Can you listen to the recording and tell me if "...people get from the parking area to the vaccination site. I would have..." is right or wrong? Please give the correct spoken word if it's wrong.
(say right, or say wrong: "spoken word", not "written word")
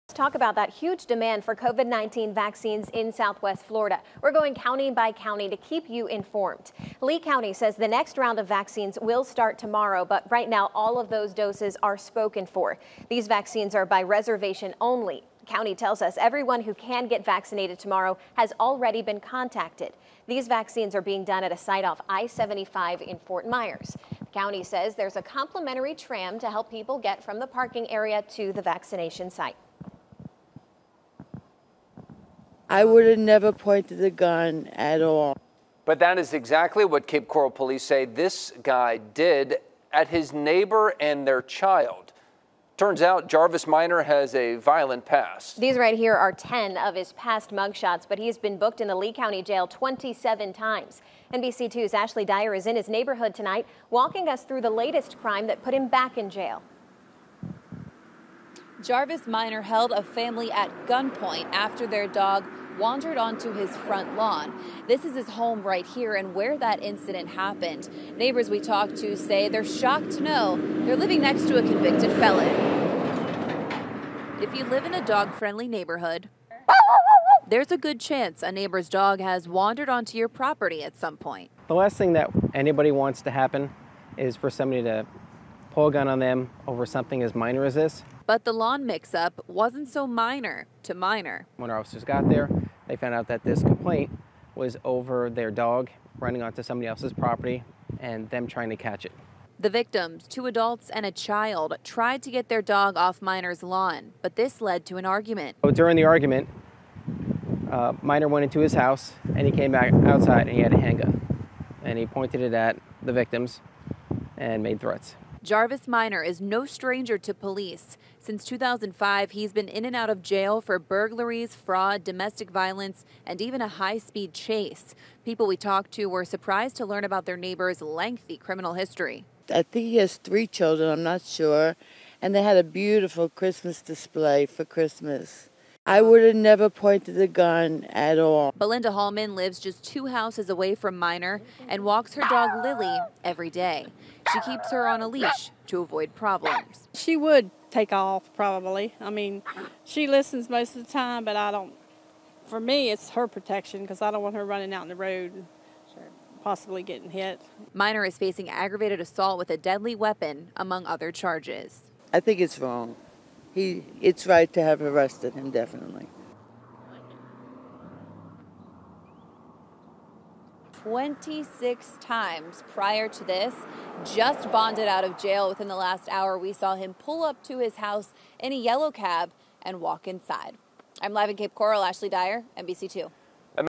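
right.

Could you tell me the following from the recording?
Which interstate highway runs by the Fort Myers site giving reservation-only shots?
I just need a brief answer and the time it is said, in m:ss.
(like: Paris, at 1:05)
I-75, at 0:22.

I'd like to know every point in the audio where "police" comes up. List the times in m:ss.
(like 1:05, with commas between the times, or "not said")
0:37, 1:57.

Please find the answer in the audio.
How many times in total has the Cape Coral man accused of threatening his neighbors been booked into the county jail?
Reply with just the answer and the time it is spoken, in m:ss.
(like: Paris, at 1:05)
27, at 0:49.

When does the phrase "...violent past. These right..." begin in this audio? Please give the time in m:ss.
0:44.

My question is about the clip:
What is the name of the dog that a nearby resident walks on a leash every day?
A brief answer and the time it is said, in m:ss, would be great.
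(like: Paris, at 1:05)
Lily, at 2:22.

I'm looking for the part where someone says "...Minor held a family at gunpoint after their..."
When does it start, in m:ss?
0:59.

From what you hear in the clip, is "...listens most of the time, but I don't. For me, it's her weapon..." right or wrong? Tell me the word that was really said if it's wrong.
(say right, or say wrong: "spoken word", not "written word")
wrong: "protection", not "weapon".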